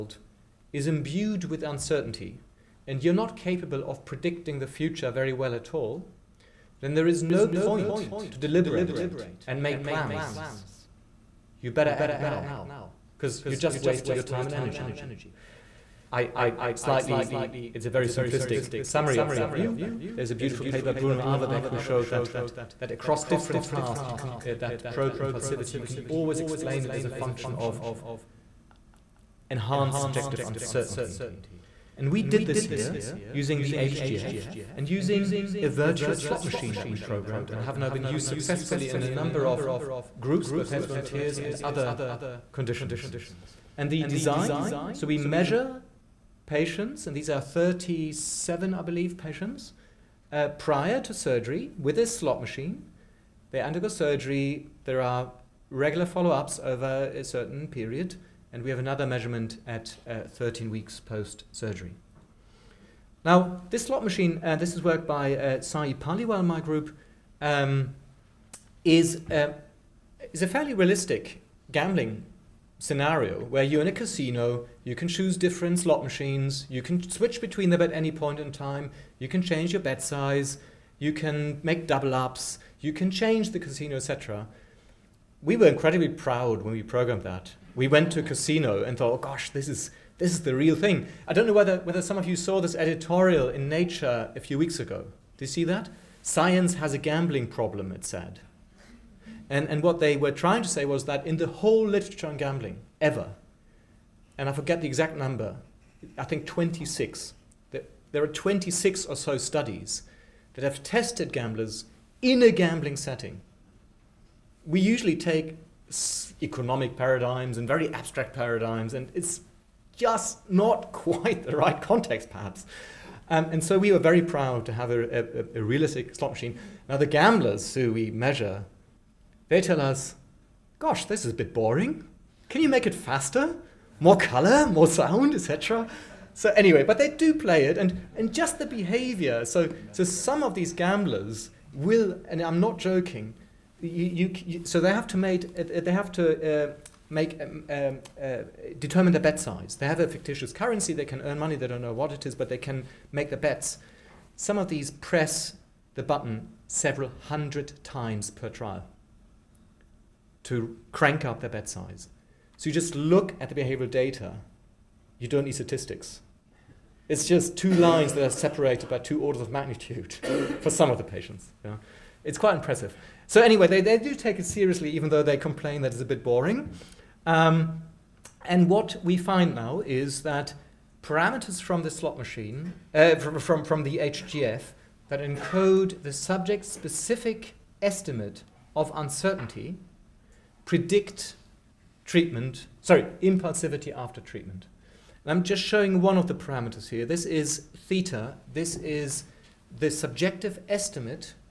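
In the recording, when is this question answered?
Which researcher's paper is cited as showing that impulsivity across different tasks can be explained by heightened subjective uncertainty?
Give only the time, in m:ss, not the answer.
0:20.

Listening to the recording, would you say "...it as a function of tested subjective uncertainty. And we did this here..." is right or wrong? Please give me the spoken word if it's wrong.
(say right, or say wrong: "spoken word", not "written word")
wrong: "enhanced", not "tested".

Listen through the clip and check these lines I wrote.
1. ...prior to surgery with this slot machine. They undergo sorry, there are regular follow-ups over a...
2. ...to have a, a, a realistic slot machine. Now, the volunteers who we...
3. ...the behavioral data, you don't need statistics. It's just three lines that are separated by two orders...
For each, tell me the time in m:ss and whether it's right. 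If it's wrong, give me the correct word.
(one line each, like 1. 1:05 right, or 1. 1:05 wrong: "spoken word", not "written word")
1. 0:50 wrong: "surgery", not "sorry"
2. 2:04 wrong: "gamblers", not "volunteers"
3. 2:43 wrong: "two", not "three".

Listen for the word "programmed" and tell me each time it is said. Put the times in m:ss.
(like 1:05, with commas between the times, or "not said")
0:36, 1:26.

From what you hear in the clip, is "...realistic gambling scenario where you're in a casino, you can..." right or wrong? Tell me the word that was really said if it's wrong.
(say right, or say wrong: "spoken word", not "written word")
right.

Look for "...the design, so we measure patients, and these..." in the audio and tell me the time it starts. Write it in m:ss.
0:43.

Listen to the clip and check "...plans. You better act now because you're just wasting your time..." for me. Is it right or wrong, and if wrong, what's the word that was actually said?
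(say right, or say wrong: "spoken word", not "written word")
right.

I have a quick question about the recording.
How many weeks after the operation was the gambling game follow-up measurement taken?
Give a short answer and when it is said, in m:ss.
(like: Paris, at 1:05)
13, at 1:00.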